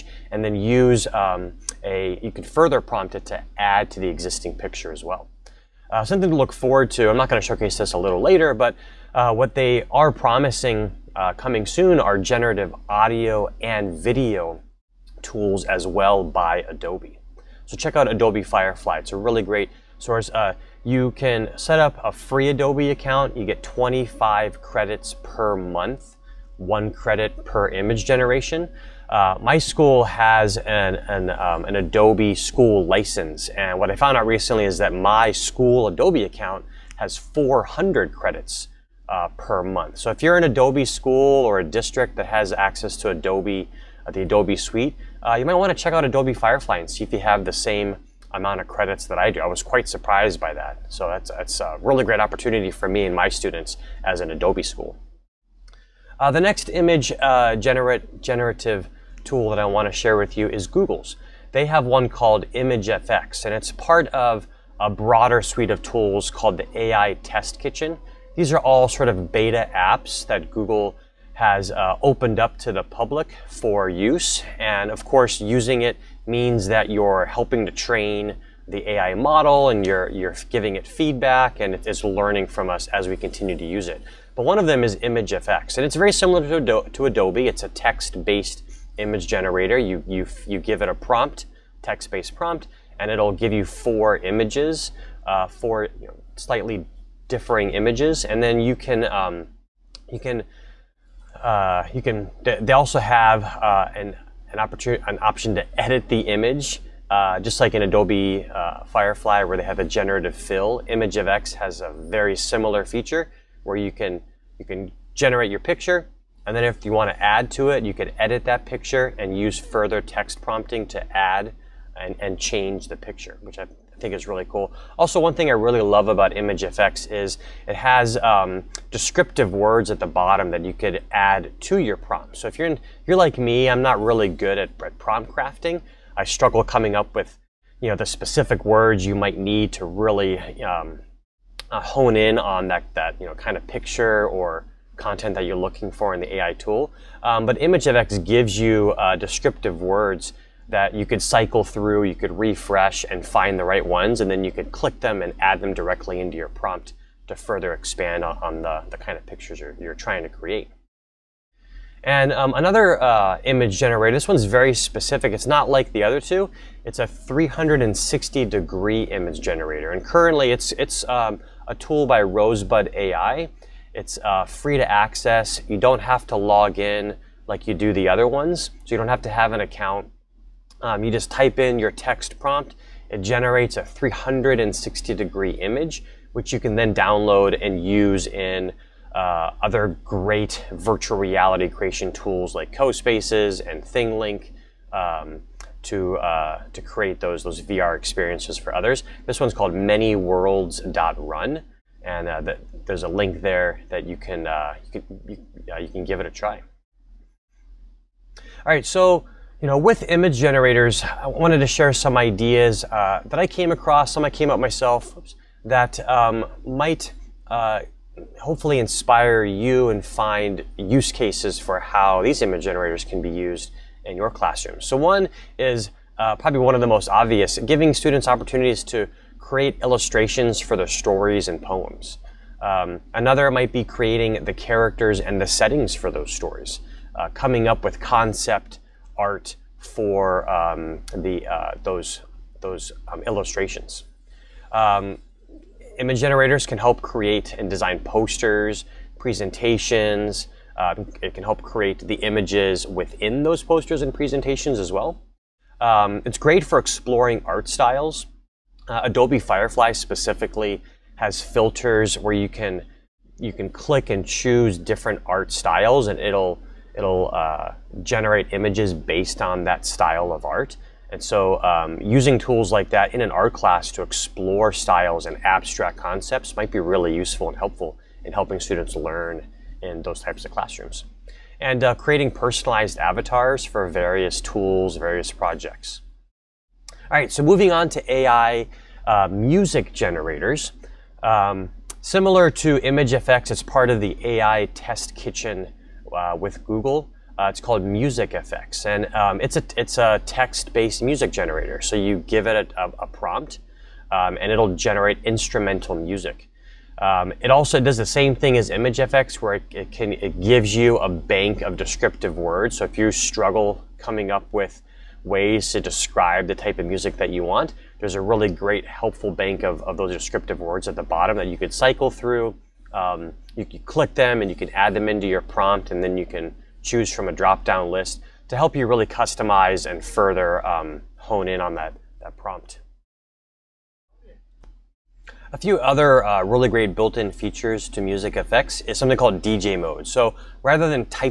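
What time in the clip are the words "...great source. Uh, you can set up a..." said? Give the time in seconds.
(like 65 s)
19 s.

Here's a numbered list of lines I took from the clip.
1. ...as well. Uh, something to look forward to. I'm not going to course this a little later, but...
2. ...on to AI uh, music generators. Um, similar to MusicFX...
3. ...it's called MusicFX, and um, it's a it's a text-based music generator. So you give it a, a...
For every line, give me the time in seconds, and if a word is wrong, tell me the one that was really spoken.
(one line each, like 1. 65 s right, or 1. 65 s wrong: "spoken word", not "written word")
1. 4 s wrong: "showcase", not "course"
2. 287 s wrong: "ImageFX", not "MusicFX"
3. 297 s right.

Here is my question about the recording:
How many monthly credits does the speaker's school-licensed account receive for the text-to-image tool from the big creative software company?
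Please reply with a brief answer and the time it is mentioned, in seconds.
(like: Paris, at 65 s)
400, at 37 s.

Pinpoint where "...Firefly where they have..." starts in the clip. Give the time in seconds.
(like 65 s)
108 s.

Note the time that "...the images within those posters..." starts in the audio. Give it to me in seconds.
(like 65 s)
252 s.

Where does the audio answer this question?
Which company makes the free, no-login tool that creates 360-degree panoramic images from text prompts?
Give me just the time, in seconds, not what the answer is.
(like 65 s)
172 s.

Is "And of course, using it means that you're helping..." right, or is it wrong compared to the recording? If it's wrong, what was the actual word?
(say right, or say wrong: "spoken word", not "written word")
right.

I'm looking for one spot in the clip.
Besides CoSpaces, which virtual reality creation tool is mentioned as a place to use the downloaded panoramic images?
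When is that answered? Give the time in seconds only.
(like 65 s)
193 s.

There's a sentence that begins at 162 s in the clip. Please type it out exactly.
And um, another uh, image generator, this one's very specific.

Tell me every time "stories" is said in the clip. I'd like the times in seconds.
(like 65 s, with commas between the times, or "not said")
230 s, 236 s.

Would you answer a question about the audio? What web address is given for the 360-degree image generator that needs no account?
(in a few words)
manyworlds.run.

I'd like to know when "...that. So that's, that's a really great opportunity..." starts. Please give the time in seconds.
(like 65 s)
50 s.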